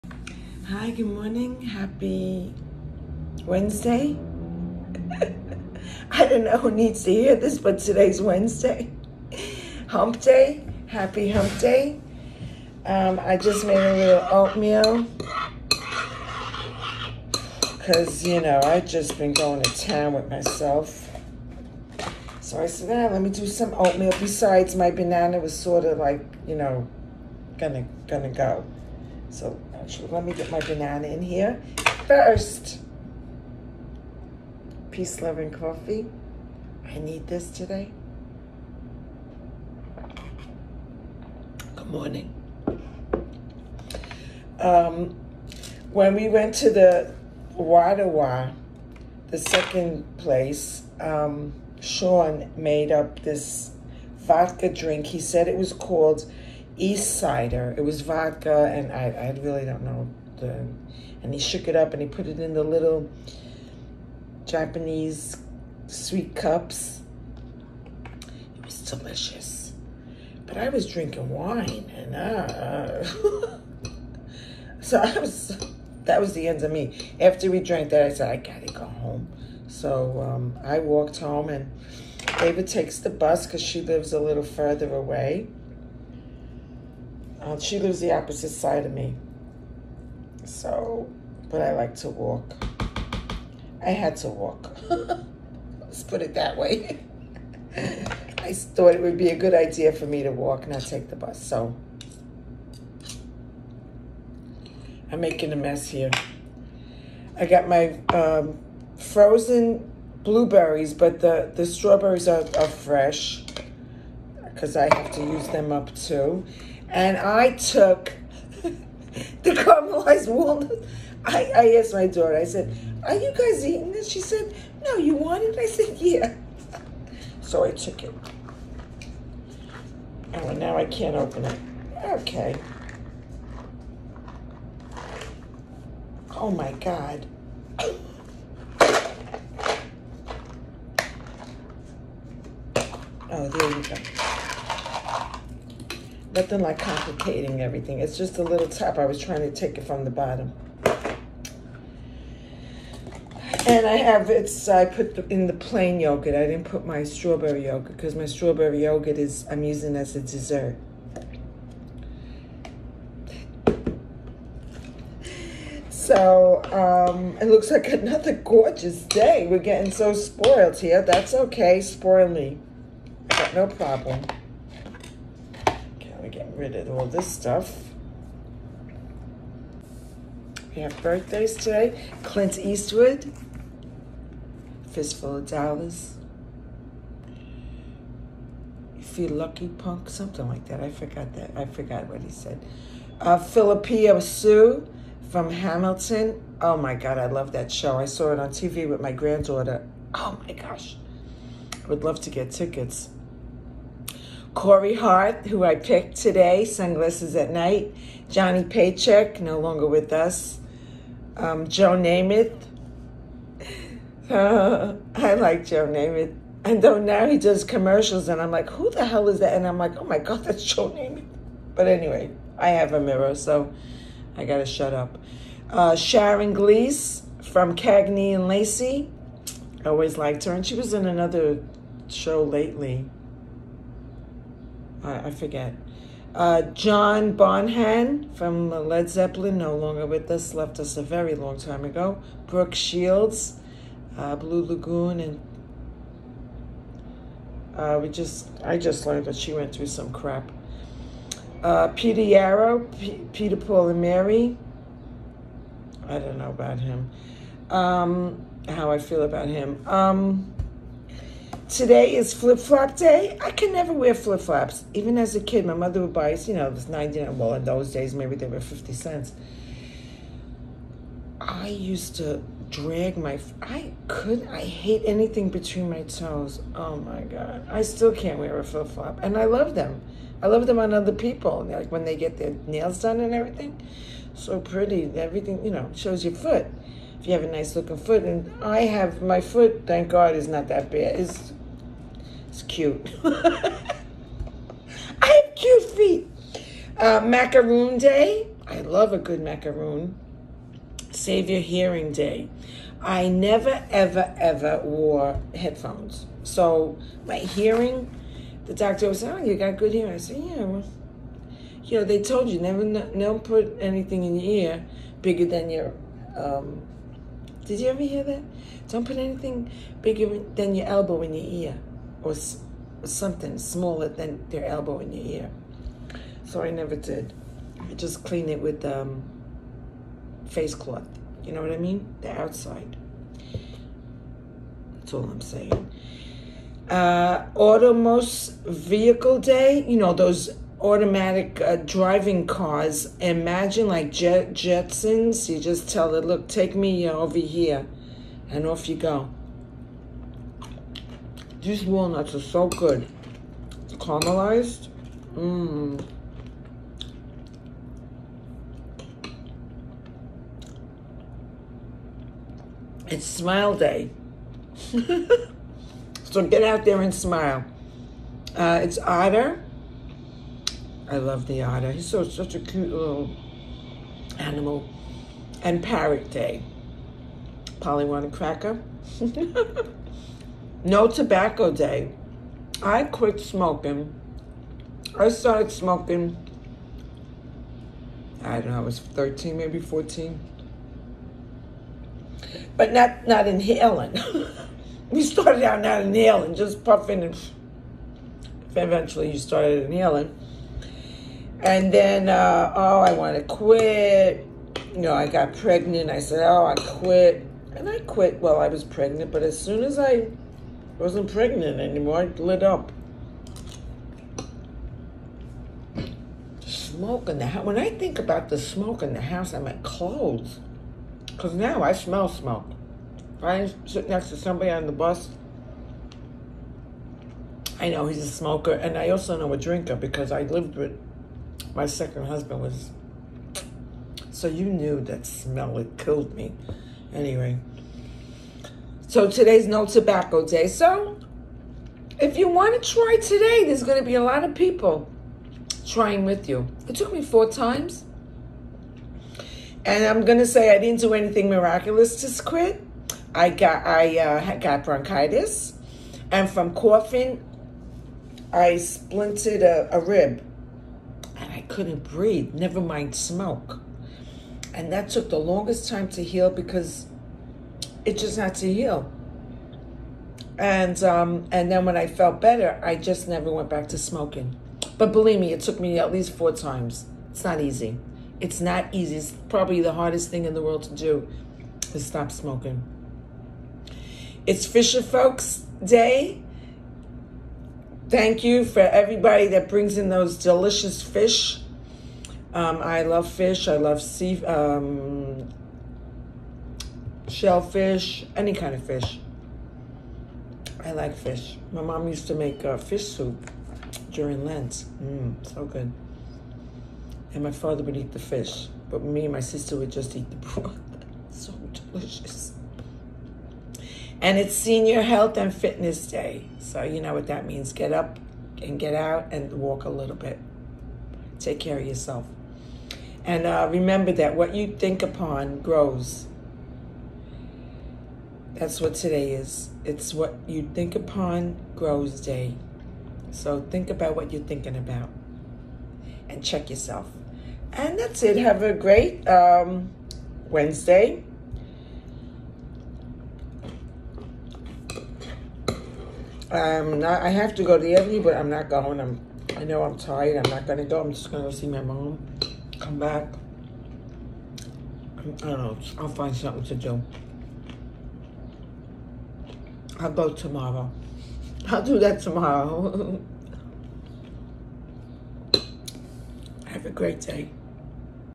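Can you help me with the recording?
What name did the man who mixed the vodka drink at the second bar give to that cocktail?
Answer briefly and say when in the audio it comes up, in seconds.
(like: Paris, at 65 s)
East Cider, at 56 s.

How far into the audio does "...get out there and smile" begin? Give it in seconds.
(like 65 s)
366 s.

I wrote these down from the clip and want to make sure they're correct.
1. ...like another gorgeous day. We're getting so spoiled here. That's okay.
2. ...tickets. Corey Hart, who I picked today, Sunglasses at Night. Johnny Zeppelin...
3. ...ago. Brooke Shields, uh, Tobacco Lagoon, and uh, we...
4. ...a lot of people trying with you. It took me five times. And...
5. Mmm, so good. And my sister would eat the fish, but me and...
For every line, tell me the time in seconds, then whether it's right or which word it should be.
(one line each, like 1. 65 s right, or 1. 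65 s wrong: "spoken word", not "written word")
1. 167 s right
2. 202 s wrong: "Paycheck", not "Zeppelin"
3. 241 s wrong: "Blue", not "Tobacco"
4. 444 s wrong: "four", not "five"
5. 505 s wrong: "father", not "sister".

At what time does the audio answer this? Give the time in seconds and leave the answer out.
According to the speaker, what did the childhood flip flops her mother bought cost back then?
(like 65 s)
268 s.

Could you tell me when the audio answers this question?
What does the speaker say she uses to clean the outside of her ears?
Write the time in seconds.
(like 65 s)
330 s.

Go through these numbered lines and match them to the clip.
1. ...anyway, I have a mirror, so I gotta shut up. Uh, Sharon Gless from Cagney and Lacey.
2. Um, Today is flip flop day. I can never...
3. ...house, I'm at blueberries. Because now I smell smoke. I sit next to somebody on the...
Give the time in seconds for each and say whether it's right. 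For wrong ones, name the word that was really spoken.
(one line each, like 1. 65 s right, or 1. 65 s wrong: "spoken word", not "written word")
1. 221 s right
2. 259 s right
3. 419 s wrong: "clothes", not "blueberries".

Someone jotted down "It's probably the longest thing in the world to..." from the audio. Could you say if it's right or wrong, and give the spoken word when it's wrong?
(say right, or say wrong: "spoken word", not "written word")
wrong: "hardest", not "longest".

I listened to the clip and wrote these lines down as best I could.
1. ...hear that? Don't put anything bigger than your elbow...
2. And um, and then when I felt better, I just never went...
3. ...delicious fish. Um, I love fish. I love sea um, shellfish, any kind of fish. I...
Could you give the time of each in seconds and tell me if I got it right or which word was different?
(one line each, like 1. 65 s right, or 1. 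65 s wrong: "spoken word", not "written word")
1. 318 s right
2. 470 s right
3. 490 s right.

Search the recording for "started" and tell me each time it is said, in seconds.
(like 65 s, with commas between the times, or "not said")
385 s, 395 s, 399 s.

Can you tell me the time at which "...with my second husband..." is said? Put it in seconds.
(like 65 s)
430 s.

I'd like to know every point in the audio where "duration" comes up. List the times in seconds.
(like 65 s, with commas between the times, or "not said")
not said.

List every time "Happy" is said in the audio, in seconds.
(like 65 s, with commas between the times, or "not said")
1 s, 10 s.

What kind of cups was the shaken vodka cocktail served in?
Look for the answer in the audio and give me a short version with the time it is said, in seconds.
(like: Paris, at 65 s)
Japanese sweet cups, at 64 s.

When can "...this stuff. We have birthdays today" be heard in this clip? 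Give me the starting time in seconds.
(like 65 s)
177 s.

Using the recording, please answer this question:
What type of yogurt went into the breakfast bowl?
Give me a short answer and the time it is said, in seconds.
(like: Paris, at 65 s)
plain yogurt, at 155 s.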